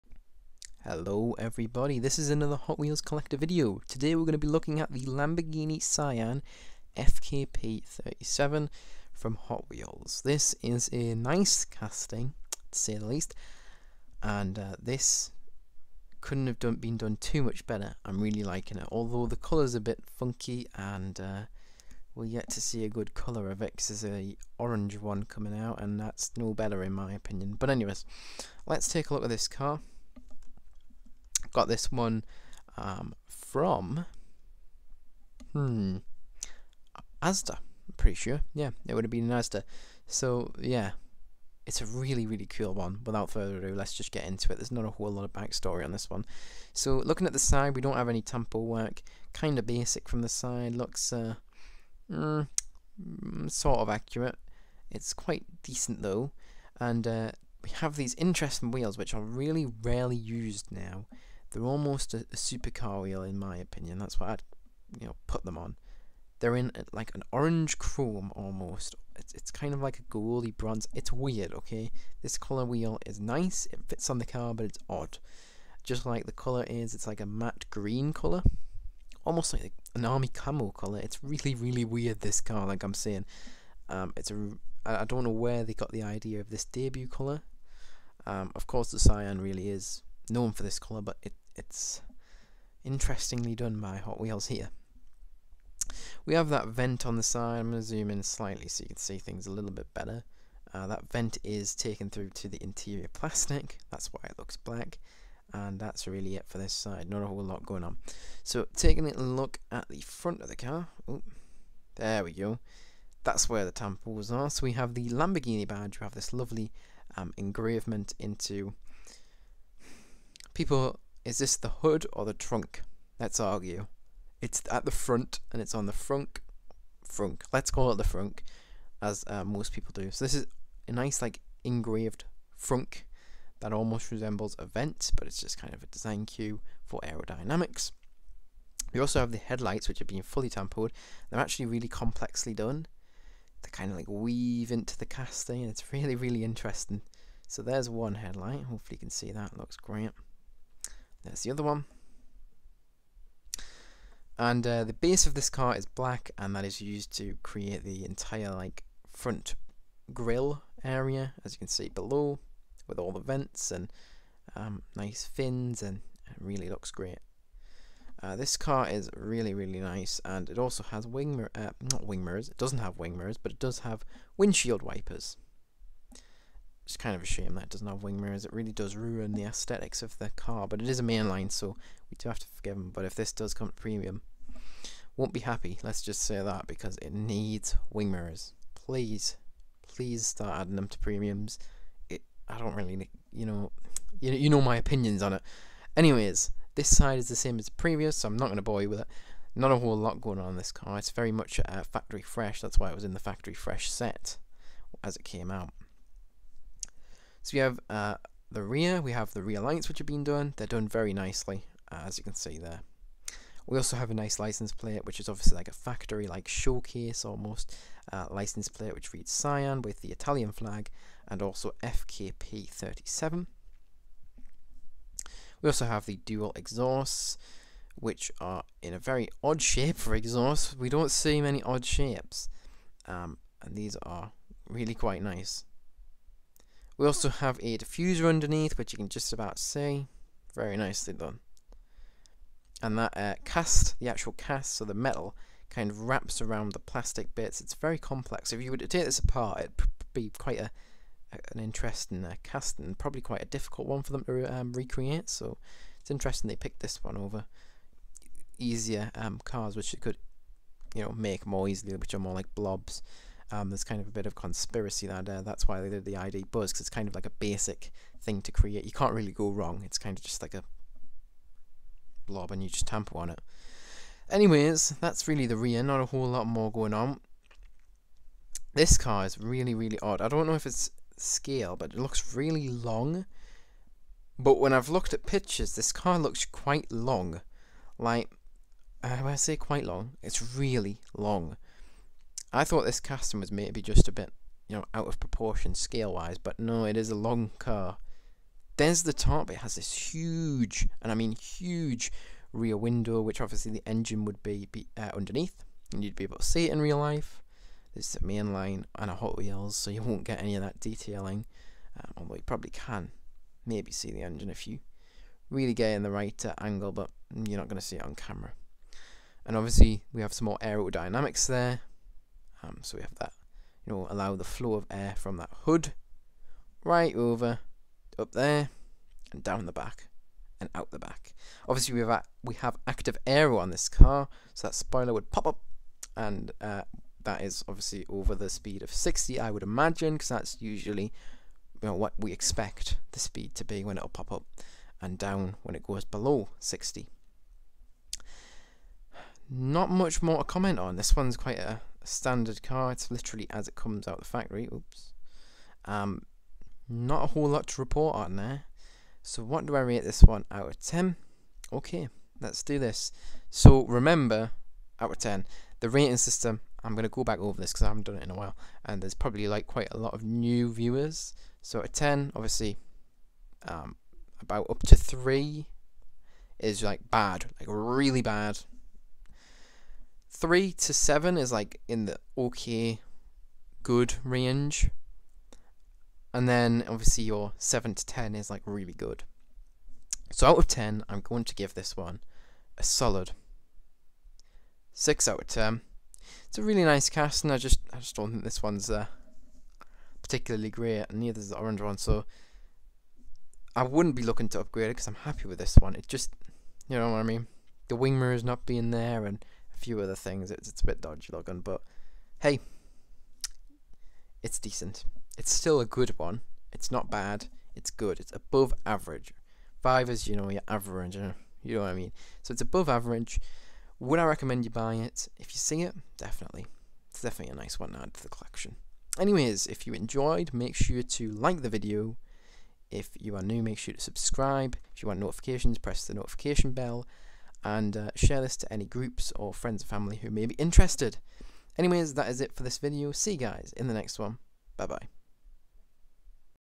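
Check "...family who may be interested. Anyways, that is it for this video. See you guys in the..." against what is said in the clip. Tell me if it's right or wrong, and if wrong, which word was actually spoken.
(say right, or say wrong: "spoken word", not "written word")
right.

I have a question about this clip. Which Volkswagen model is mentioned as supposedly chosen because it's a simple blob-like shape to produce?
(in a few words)
ID Buzz.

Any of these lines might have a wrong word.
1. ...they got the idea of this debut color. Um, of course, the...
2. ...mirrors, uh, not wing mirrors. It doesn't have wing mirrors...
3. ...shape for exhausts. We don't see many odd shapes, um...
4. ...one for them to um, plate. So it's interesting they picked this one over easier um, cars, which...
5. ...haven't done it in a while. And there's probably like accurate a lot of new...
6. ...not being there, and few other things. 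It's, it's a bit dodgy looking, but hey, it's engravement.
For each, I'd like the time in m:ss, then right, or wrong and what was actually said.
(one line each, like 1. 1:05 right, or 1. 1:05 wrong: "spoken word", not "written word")
1. 1:25 right
2. 2:51 right
3. 3:49 right
4. 4:13 wrong: "recreate", not "plate"
5. 6:07 wrong: "quite", not "accurate"
6. 6:48 wrong: "decent", not "engravement".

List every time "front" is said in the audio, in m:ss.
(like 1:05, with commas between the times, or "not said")
1:49, 2:04, 2:39.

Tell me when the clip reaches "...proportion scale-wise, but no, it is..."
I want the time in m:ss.
4:55.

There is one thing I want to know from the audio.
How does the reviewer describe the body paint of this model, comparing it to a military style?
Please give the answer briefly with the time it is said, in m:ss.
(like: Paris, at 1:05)
army camo color, at 1:20.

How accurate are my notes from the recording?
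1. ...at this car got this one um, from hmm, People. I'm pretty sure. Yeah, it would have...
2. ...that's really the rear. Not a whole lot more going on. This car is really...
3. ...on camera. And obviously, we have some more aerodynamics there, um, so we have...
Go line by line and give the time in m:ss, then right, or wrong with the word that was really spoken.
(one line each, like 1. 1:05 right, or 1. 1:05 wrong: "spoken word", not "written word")
1. 0:29 wrong: "Asda", not "People"
2. 4:35 right
3. 5:18 right.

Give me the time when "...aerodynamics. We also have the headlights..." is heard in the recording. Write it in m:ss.
2:17.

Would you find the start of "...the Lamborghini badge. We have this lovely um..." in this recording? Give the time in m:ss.
1:54.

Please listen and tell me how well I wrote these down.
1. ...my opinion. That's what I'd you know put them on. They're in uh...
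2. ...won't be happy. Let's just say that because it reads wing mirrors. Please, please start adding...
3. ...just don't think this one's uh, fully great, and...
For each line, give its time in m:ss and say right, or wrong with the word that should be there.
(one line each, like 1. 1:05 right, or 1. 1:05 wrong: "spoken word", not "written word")
1. 1:03 right
2. 3:05 wrong: "needs", not "reads"
3. 6:37 wrong: "particularly", not "fully".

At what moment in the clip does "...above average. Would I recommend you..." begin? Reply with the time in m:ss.
7:02.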